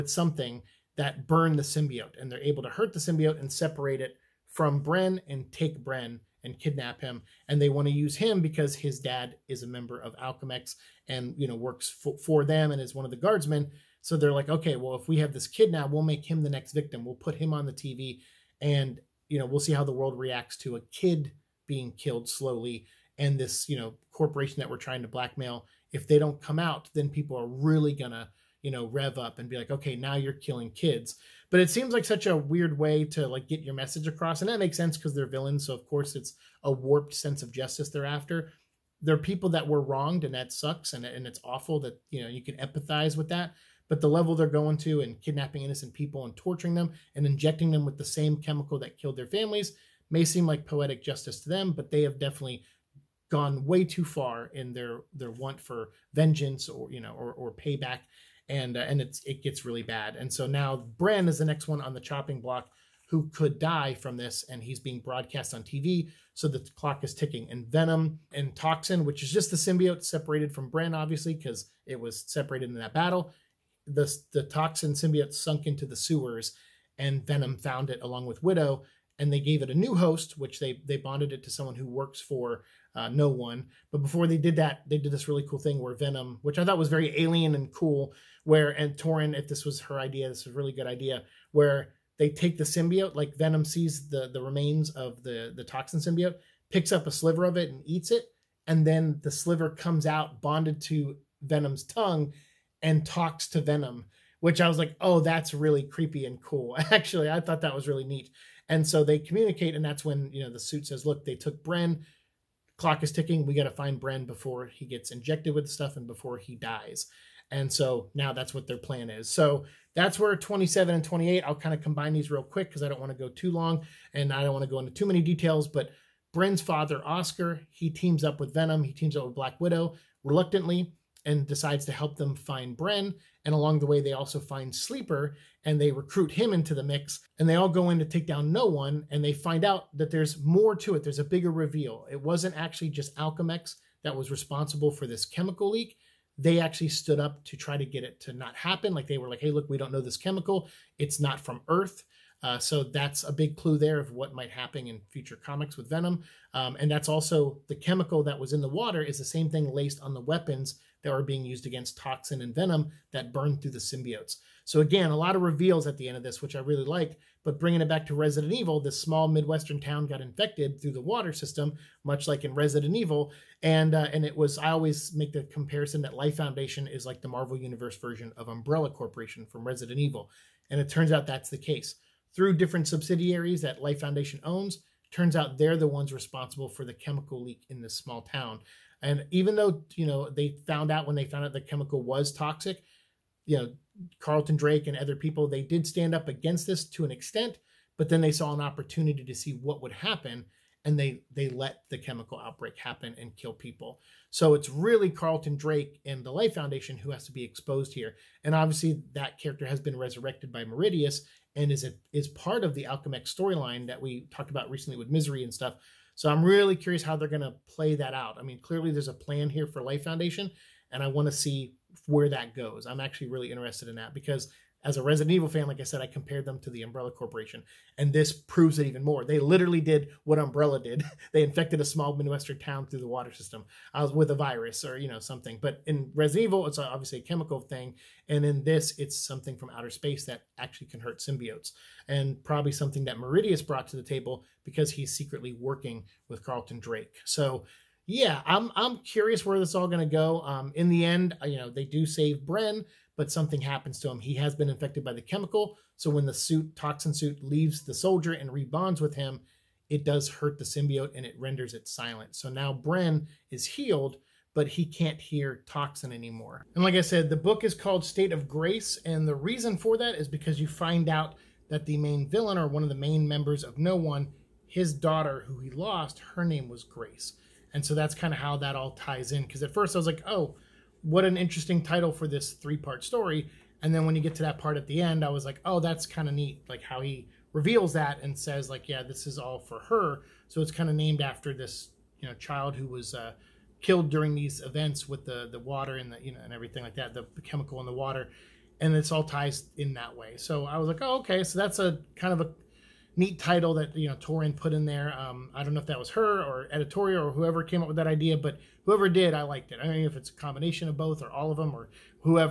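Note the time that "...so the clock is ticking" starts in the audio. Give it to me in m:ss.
1:06.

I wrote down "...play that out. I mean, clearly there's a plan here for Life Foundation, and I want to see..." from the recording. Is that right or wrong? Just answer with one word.
right.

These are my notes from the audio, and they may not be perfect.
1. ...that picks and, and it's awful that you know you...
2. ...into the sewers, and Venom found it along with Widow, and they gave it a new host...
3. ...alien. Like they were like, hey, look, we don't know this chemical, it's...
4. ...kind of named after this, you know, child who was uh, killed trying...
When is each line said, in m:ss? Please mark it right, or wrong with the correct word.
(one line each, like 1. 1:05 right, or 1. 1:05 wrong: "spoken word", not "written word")
1. 0:40 wrong: "sucks", not "picks"
2. 1:15 right
3. 2:28 wrong: "happen", not "alien"
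4. 4:50 wrong: "during", not "trying".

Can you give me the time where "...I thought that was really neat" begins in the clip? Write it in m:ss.
1:47.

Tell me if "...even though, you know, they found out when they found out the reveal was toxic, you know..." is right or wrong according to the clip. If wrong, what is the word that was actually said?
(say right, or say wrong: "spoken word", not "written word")
wrong: "chemical", not "reveal".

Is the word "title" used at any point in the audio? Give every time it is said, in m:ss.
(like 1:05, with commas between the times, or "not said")
4:41, 5:03.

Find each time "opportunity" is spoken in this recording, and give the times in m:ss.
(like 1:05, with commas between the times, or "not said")
3:18.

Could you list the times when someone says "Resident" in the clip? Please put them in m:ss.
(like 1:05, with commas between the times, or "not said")
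2:48, 2:52, 2:59, 3:45, 3:56.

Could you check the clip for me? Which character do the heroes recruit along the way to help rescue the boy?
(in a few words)
Sleeper.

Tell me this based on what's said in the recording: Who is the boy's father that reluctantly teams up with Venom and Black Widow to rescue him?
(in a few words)
Oscar.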